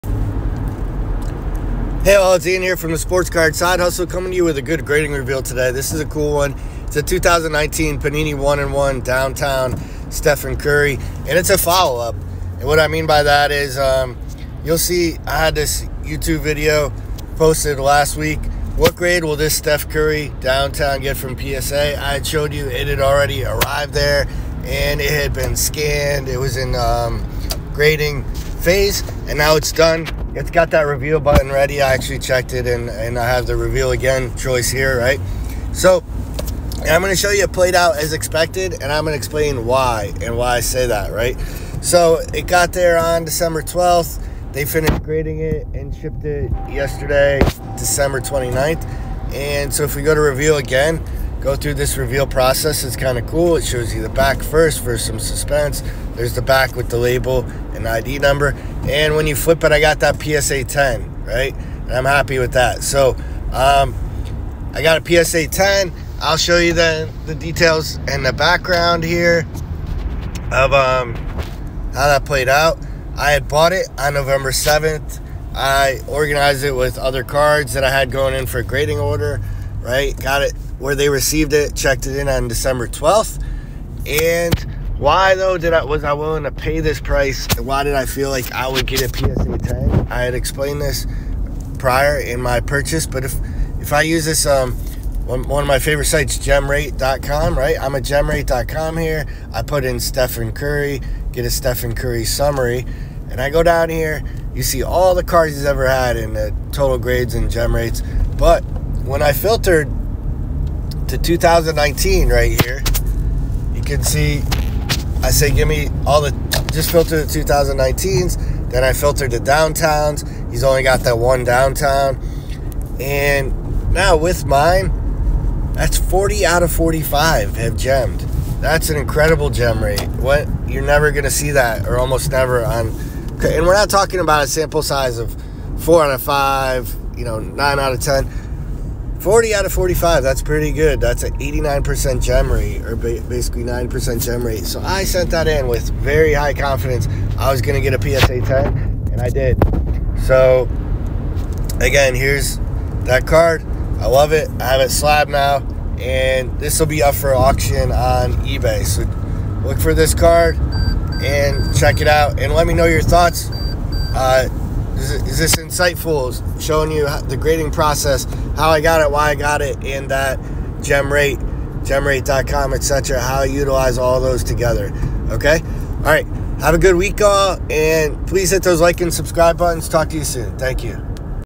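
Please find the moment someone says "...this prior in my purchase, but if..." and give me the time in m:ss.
1:30.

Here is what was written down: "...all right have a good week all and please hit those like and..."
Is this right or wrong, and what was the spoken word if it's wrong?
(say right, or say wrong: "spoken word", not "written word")
right.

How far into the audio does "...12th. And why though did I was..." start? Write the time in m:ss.
1:22.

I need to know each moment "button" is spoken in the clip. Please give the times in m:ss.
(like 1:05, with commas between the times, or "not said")
0:31, 2:59.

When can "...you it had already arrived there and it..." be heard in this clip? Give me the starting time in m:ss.
0:22.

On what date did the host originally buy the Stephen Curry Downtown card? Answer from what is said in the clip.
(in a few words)
November 7th.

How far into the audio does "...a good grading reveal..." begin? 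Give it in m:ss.
0:04.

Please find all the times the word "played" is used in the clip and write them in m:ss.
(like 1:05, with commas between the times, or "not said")
0:37, 1:12.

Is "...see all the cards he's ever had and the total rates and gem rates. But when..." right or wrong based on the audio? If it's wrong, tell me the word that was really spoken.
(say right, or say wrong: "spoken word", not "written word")
wrong: "grades", not "rates".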